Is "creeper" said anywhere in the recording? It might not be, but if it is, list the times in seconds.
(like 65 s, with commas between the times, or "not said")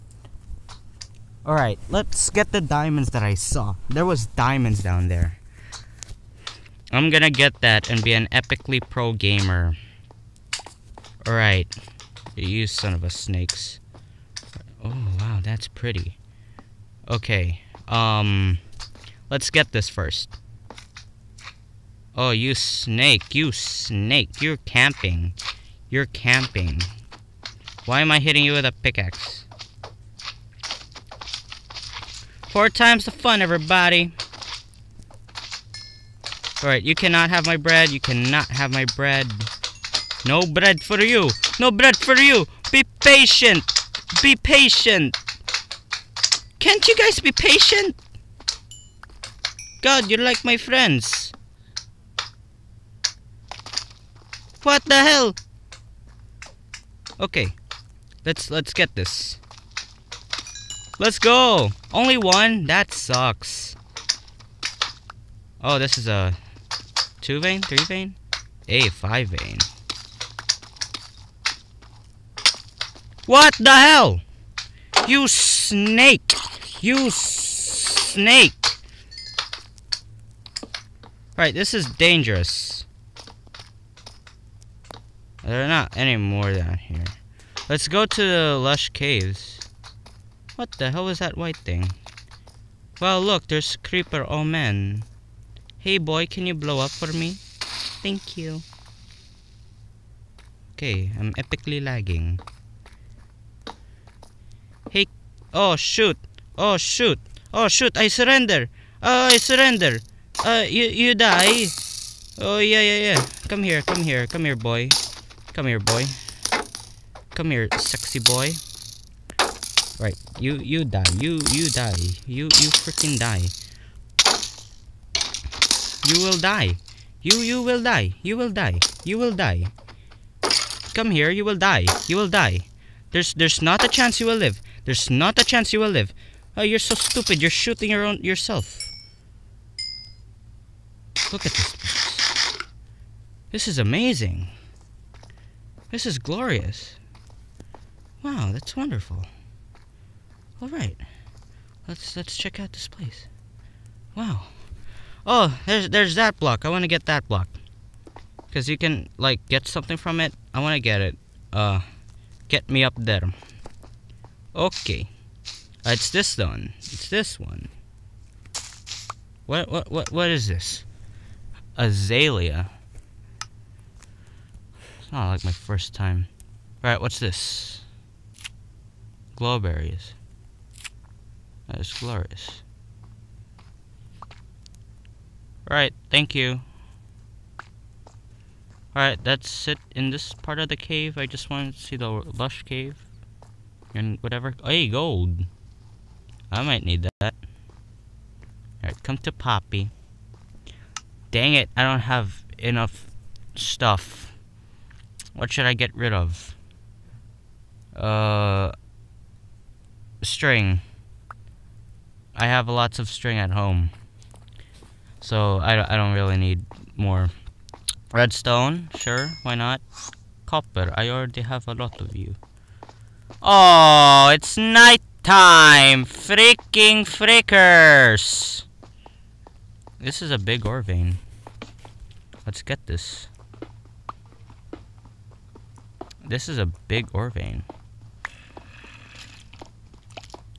93 s.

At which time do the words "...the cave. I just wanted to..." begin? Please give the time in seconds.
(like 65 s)
190 s.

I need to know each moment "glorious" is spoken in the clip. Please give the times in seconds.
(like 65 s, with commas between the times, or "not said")
146 s, 181 s.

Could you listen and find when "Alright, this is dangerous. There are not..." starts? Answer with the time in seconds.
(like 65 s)
81 s.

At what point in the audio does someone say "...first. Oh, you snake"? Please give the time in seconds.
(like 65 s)
19 s.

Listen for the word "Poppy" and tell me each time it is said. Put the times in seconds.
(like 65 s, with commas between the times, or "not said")
199 s.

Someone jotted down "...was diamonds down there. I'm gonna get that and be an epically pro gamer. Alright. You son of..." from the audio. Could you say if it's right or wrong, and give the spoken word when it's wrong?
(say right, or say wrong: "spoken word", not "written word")
right.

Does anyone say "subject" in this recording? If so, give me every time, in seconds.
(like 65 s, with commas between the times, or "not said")
not said.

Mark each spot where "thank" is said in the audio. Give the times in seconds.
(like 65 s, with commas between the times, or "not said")
97 s, 186 s.